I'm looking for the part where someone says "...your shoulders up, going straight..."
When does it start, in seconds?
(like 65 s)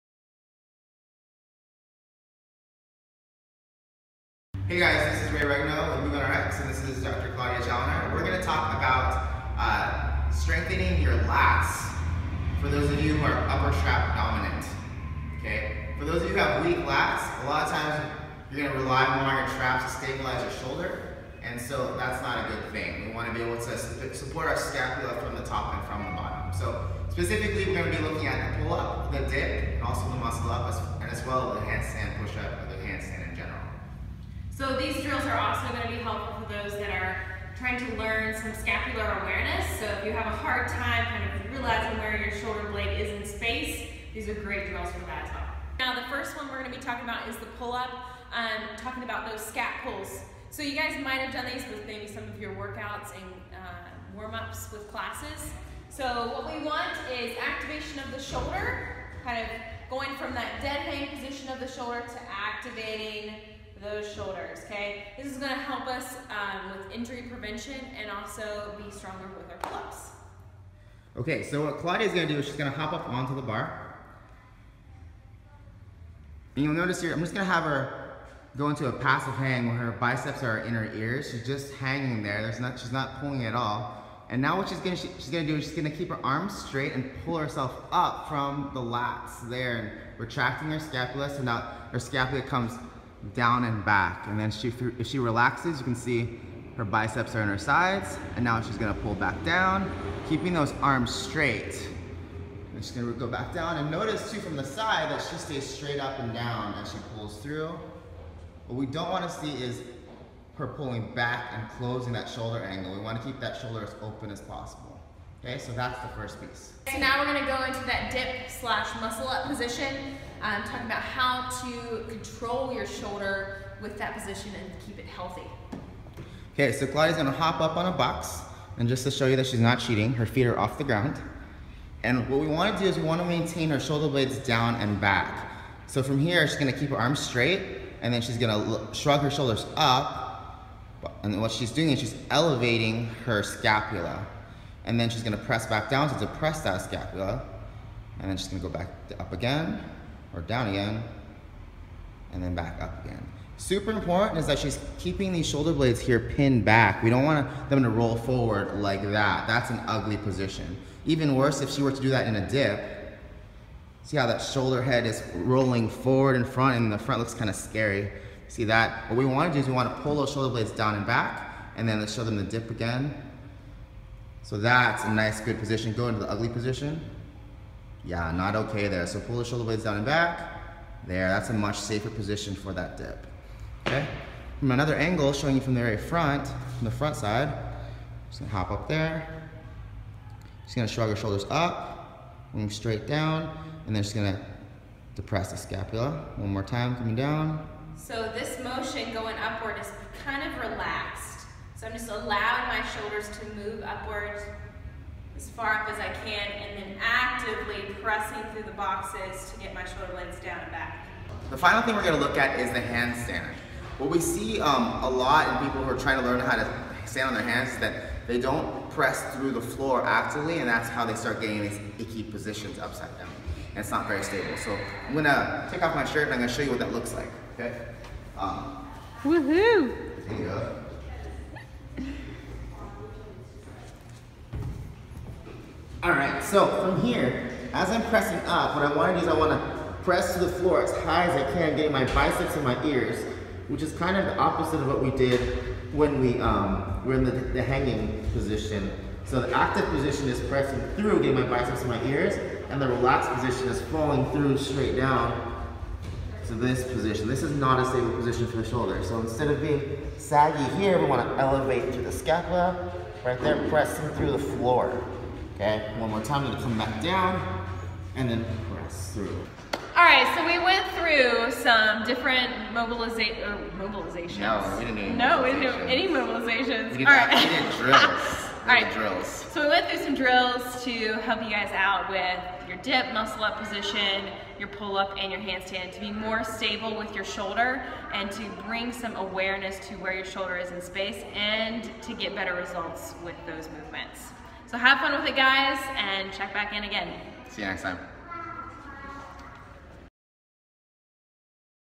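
191 s.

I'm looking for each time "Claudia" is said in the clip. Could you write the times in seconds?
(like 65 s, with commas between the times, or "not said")
7 s, 71 s, 126 s.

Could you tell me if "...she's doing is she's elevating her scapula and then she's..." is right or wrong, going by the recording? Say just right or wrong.
right.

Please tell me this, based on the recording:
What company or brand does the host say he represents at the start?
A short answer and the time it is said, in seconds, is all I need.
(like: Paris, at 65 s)
Movement RX, at 6 s.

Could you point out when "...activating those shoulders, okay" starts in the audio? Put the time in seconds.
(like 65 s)
62 s.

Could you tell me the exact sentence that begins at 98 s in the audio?
And now she's gonna pull back down, keeping those arms straight.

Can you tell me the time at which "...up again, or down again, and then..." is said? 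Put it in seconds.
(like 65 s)
149 s.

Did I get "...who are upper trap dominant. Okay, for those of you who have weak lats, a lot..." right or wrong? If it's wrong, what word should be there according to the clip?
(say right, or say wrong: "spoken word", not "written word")
right.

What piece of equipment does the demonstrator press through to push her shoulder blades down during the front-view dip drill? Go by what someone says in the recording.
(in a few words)
the boxes.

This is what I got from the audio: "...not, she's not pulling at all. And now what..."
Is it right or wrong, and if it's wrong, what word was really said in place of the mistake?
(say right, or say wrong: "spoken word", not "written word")
right.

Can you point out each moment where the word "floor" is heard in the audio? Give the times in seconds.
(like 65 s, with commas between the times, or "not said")
219 s, 240 s, 264 s.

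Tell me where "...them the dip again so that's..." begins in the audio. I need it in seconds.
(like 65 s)
172 s.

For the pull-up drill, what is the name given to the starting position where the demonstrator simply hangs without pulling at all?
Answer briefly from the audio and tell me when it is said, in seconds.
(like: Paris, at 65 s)
passive hang, at 78 s.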